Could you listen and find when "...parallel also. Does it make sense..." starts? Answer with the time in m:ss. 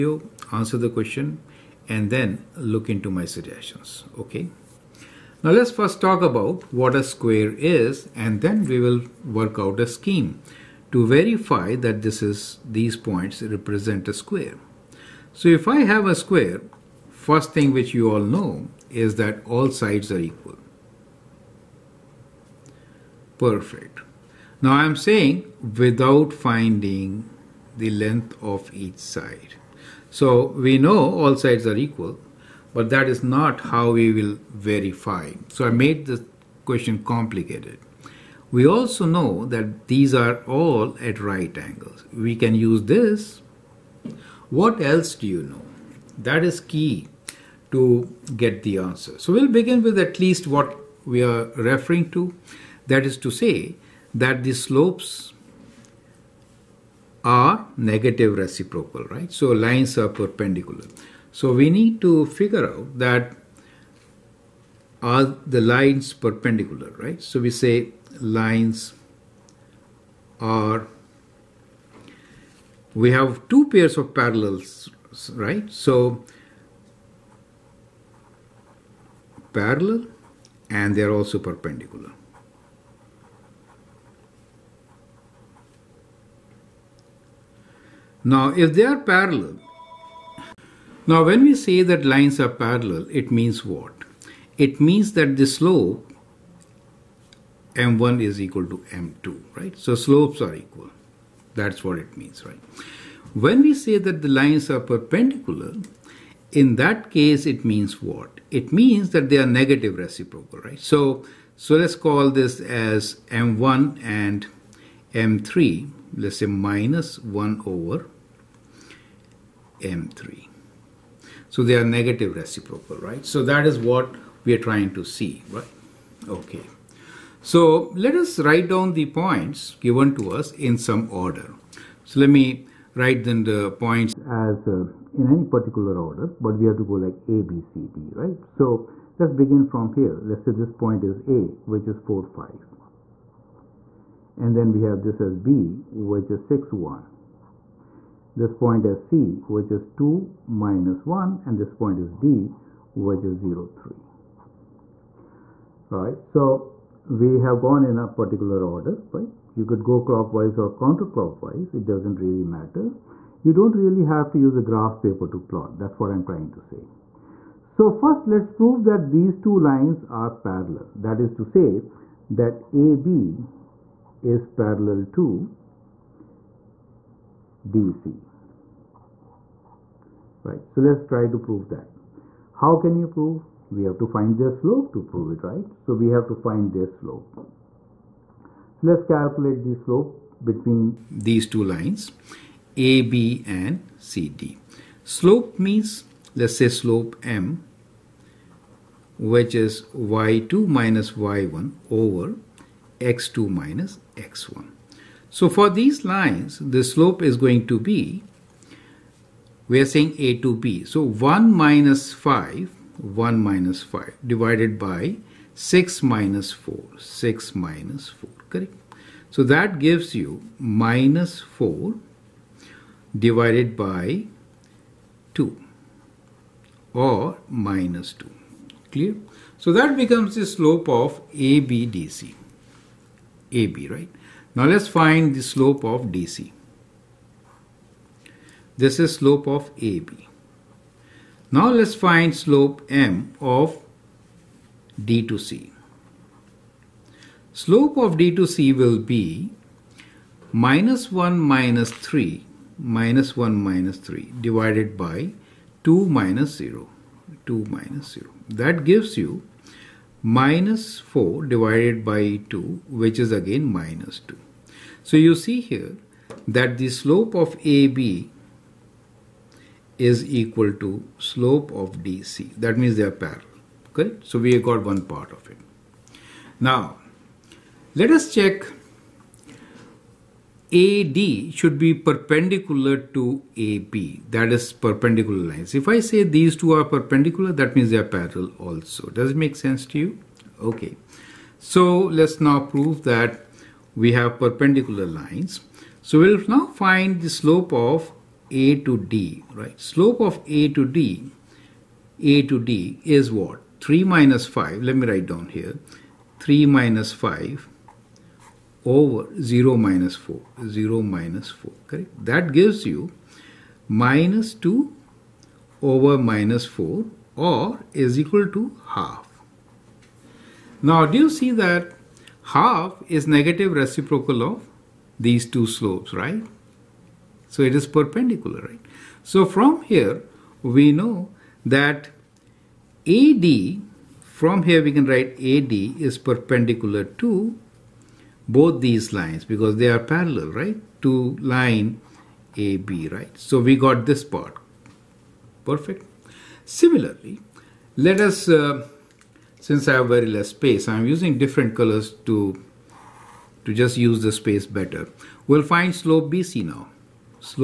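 4:48.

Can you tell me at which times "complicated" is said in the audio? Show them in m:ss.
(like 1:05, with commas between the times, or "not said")
0:37.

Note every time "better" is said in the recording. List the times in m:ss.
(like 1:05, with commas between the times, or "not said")
5:54.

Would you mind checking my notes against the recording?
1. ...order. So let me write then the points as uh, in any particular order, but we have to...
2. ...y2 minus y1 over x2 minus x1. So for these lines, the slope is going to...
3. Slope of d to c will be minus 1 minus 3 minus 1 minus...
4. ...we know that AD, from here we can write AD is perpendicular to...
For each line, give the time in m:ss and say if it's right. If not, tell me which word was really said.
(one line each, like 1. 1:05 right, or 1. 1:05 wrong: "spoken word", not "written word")
1. 2:11 right
2. 3:19 right
3. 4:07 right
4. 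5:30 right.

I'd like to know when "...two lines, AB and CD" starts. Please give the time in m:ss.
3:11.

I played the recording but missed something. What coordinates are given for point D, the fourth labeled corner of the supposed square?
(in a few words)
0, 3.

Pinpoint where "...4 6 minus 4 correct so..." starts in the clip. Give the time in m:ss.
3:36.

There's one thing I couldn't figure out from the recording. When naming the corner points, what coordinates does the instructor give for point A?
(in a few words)
4, 5.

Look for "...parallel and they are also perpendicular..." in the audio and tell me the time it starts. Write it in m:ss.
1:19.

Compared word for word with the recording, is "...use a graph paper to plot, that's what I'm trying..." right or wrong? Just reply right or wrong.
right.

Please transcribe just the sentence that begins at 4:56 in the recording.
So we'll now find the slope of a to D, right?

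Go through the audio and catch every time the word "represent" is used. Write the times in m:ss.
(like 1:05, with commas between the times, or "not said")
0:13.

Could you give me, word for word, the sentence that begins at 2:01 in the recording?
So they are negative reciprocal, right?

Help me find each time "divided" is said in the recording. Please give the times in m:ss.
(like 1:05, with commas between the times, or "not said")
3:34, 3:43, 4:14, 4:21.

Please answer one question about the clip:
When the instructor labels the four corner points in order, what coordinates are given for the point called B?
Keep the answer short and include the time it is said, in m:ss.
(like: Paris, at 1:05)
6, 1, at 2:26.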